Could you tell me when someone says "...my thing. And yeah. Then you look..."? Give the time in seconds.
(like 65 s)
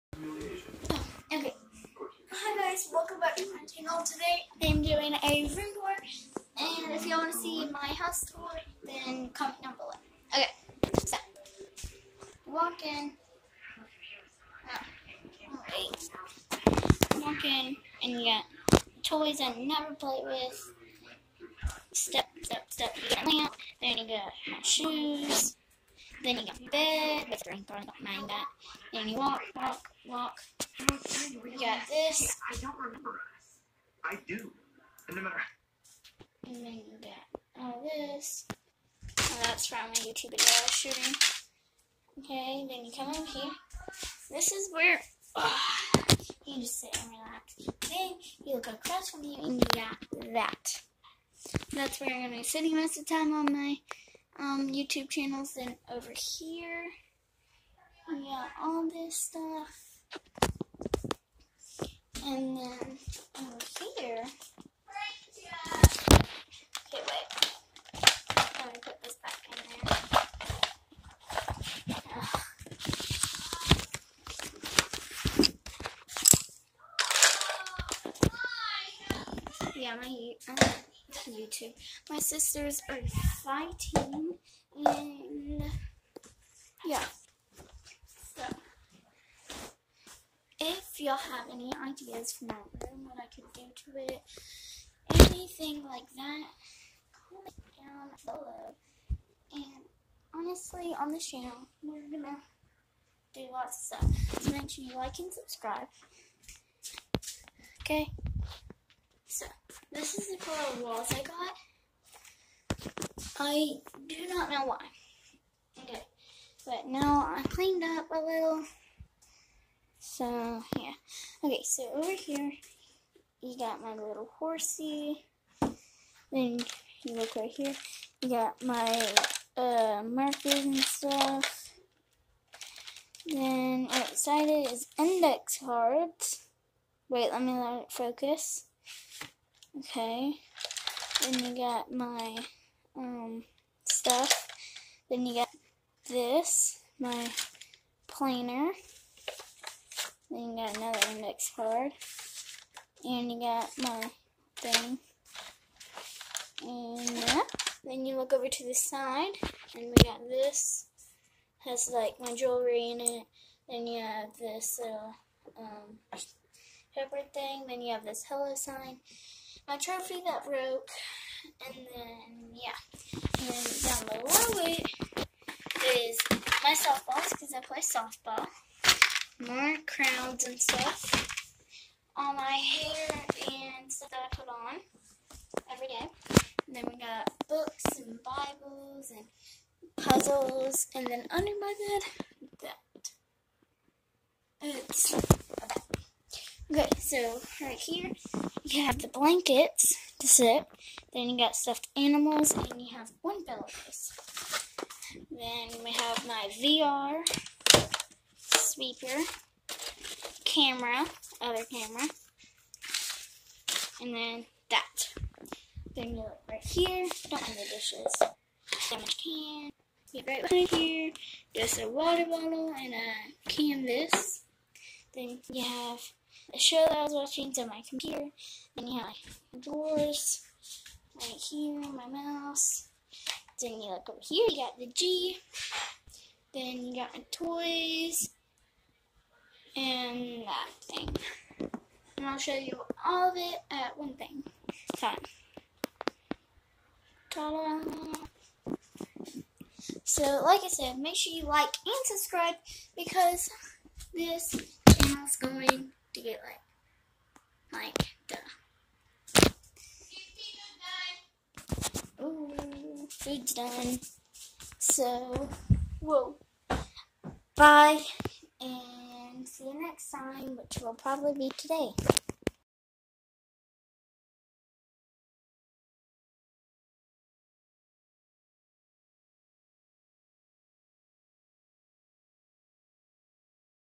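153 s.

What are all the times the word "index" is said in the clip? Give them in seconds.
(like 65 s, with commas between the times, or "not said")
134 s, 151 s.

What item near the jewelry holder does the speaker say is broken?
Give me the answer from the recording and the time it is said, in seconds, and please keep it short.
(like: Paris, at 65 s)
Trophy, at 169 s.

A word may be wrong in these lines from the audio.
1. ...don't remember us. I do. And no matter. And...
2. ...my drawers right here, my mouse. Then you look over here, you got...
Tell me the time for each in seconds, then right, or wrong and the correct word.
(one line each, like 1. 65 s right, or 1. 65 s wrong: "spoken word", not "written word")
1. 32 s right
2. 229 s right.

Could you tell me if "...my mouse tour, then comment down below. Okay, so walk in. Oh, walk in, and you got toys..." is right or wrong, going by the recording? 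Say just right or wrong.
wrong.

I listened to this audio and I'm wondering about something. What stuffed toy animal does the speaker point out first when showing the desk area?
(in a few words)
Little horsey.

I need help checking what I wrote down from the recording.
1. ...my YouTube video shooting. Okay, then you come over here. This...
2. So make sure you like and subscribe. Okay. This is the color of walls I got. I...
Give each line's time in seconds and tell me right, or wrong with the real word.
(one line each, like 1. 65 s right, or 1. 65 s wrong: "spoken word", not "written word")
1. 39 s right
2. 104 s right.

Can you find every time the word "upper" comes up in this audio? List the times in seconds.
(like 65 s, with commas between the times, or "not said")
not said.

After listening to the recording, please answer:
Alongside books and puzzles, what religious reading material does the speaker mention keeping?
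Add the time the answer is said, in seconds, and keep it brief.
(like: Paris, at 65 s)
Bibles, at 188 s.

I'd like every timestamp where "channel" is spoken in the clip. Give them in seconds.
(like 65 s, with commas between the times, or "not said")
3 s, 55 s, 101 s, 254 s.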